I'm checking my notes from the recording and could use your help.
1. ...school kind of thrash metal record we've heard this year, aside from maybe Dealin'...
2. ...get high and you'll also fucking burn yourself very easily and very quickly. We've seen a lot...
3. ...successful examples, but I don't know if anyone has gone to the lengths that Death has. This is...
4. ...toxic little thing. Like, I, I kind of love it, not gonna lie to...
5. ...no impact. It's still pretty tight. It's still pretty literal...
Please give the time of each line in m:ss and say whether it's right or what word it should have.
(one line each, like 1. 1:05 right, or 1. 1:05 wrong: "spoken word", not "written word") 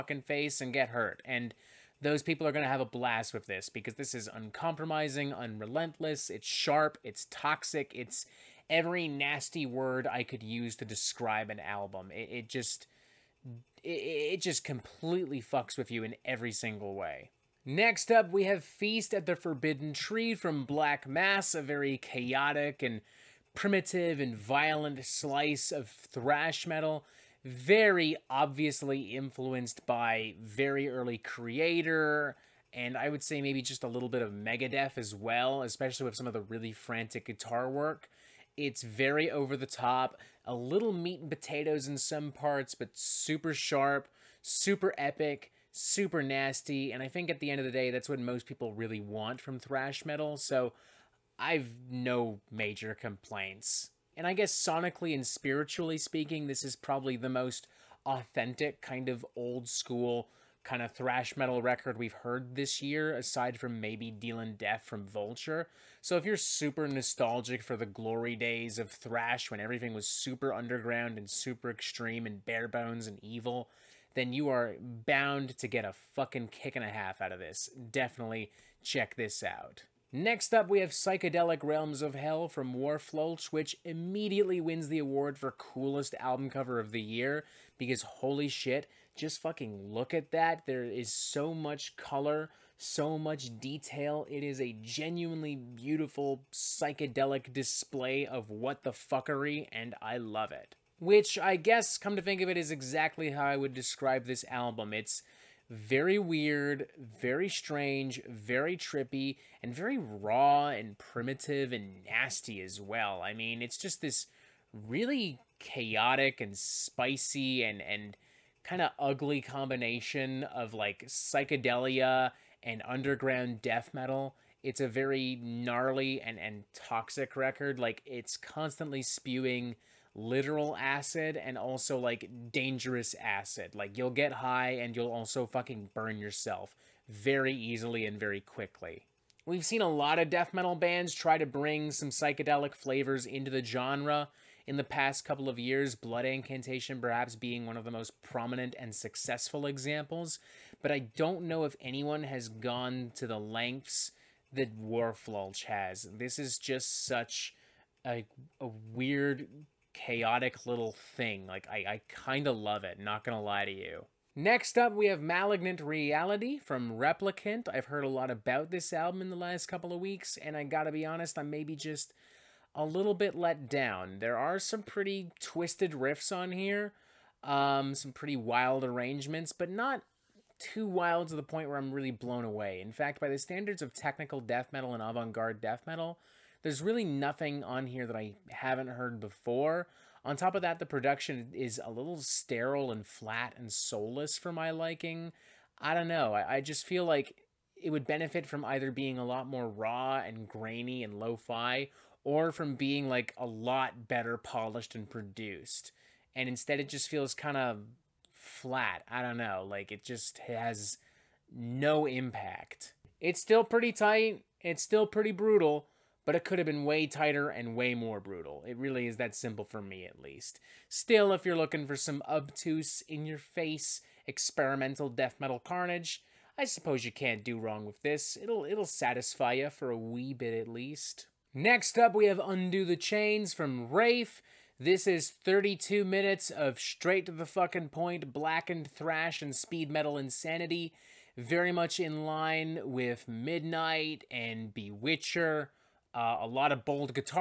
1. 0:59 right
2. 2:14 right
3. 2:28 wrong: "Wharflurch", not "Death"
4. 2:39 wrong: "chaotic", not "toxic"
5. 3:31 wrong: "brutal", not "literal".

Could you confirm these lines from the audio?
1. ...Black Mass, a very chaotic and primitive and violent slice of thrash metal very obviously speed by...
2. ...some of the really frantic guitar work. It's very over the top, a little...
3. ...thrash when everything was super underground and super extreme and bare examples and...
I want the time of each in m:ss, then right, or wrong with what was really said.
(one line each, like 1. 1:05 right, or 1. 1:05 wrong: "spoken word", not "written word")
1. 0:20 wrong: "influenced", not "speed"
2. 0:36 right
3. 1:08 wrong: "bones", not "examples".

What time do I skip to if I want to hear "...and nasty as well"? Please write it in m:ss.
1:51.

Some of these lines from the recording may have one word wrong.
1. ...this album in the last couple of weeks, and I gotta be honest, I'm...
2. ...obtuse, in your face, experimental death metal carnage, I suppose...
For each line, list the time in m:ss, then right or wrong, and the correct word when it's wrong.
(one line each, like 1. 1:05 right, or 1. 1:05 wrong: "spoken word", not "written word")
1. 2:48 right
2. 3:42 right.